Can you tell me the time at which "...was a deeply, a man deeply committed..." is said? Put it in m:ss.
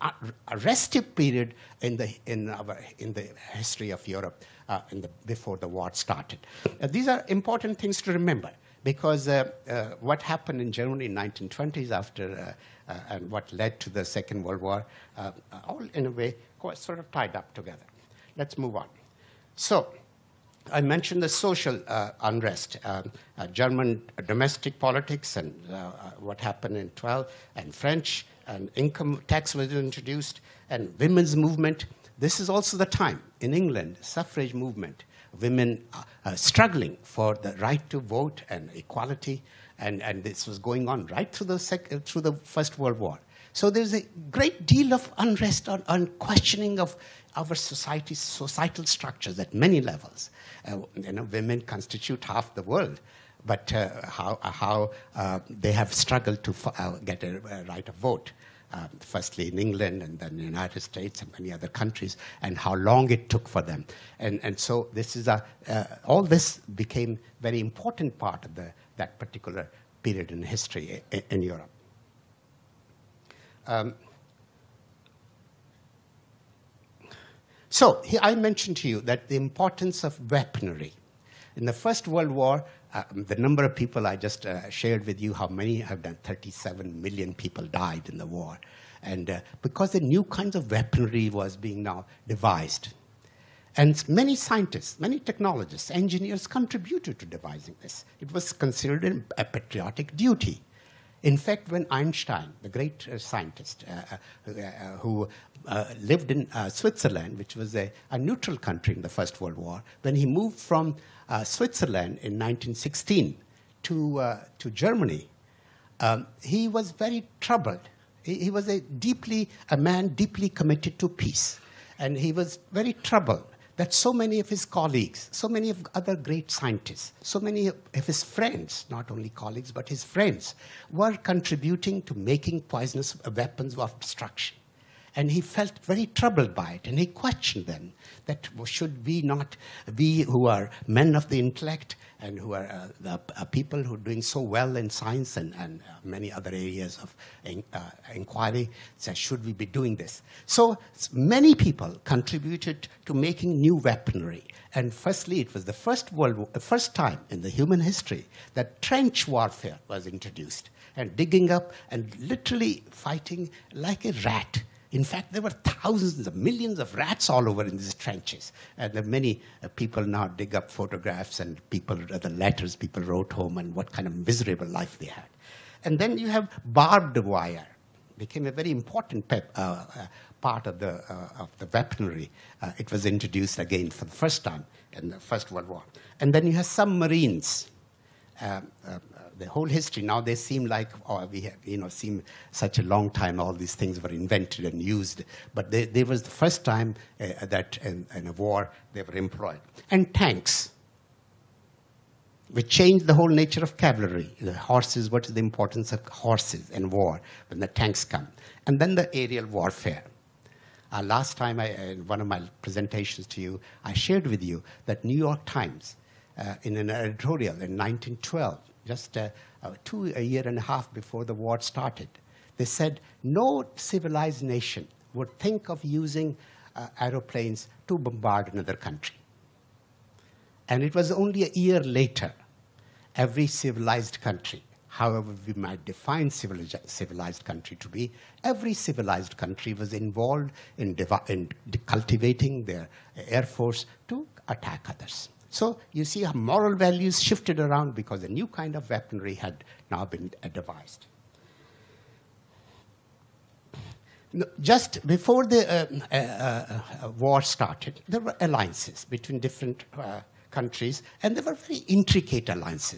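1:58.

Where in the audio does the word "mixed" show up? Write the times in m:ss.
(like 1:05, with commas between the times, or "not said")
not said.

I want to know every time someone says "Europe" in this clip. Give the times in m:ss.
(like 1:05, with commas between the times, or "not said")
0:04, 1:11.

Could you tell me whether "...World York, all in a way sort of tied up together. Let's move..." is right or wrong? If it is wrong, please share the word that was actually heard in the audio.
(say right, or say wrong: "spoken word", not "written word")
wrong: "War", not "York".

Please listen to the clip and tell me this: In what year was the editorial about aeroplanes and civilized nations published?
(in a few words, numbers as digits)
1912.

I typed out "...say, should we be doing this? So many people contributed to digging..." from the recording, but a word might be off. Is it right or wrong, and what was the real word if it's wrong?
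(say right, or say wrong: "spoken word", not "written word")
wrong: "making", not "digging".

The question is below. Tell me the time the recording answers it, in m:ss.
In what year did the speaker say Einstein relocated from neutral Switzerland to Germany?
1:52.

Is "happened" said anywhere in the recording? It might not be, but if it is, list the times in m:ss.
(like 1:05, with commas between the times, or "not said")
0:10, 0:26.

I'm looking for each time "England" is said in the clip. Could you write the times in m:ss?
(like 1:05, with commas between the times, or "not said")
0:33, 0:59.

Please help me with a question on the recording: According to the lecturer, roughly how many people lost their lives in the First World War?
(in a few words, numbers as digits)
37 million.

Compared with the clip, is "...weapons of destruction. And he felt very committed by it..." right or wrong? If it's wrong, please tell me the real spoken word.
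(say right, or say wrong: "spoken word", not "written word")
wrong: "troubled", not "committed".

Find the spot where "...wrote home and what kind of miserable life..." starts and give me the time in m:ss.
2:53.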